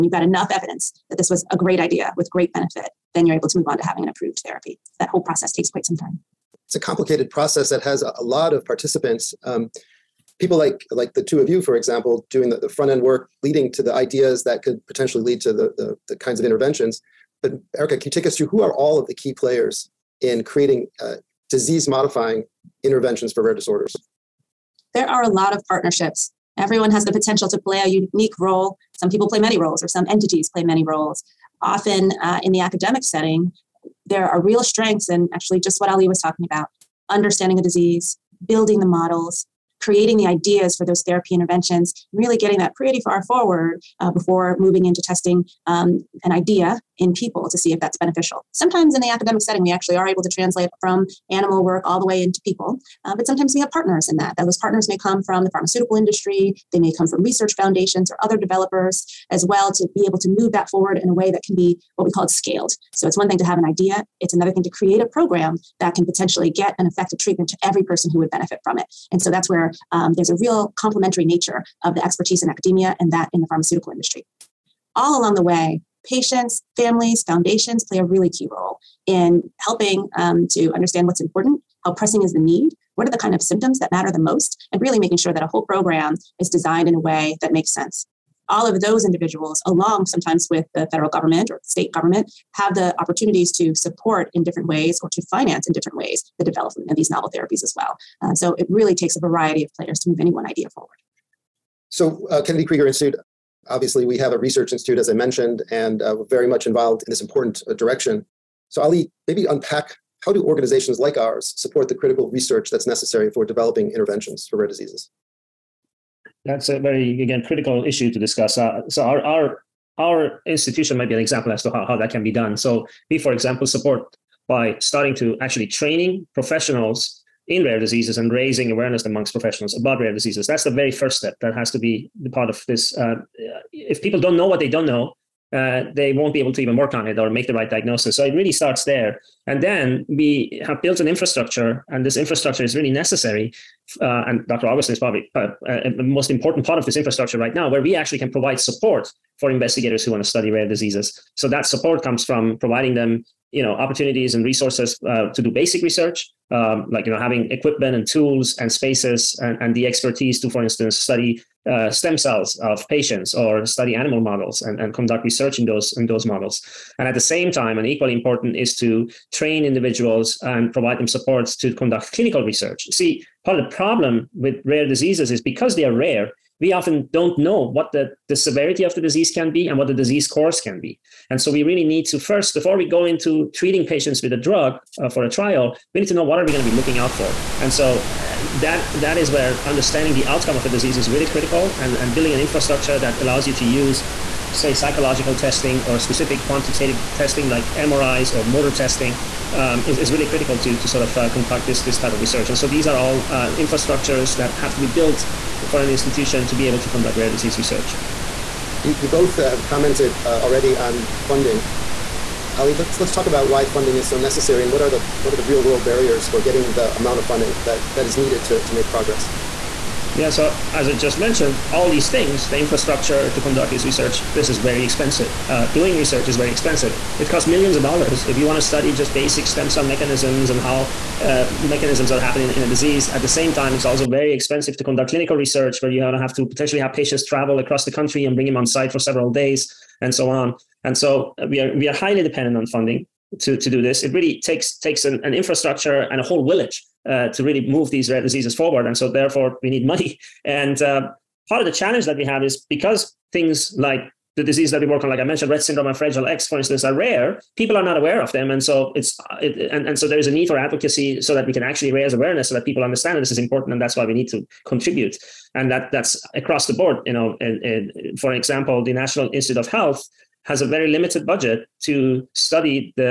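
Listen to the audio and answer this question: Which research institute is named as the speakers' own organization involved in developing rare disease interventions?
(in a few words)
Kennedy Krieger Institute.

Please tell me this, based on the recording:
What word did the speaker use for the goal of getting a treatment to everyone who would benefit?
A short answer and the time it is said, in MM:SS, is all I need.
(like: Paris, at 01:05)
scaled, at 01:02.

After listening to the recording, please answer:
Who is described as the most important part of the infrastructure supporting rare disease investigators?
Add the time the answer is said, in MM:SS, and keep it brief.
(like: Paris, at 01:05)
Dr. Augustine, at 02:24.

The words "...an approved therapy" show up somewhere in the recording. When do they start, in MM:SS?
00:04.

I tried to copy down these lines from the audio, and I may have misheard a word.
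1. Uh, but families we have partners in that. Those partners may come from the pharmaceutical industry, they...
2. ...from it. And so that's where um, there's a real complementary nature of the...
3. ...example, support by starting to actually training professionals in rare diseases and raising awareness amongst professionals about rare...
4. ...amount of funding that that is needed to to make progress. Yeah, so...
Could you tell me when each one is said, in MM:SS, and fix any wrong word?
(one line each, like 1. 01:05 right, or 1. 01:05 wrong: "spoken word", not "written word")
1. 00:53 wrong: "sometimes", not "families"
2. 01:08 right
3. 02:03 right
4. 03:36 right.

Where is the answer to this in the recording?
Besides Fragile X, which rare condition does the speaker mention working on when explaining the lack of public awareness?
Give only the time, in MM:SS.
04:15.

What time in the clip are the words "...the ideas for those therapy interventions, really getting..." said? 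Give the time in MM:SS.
00:40.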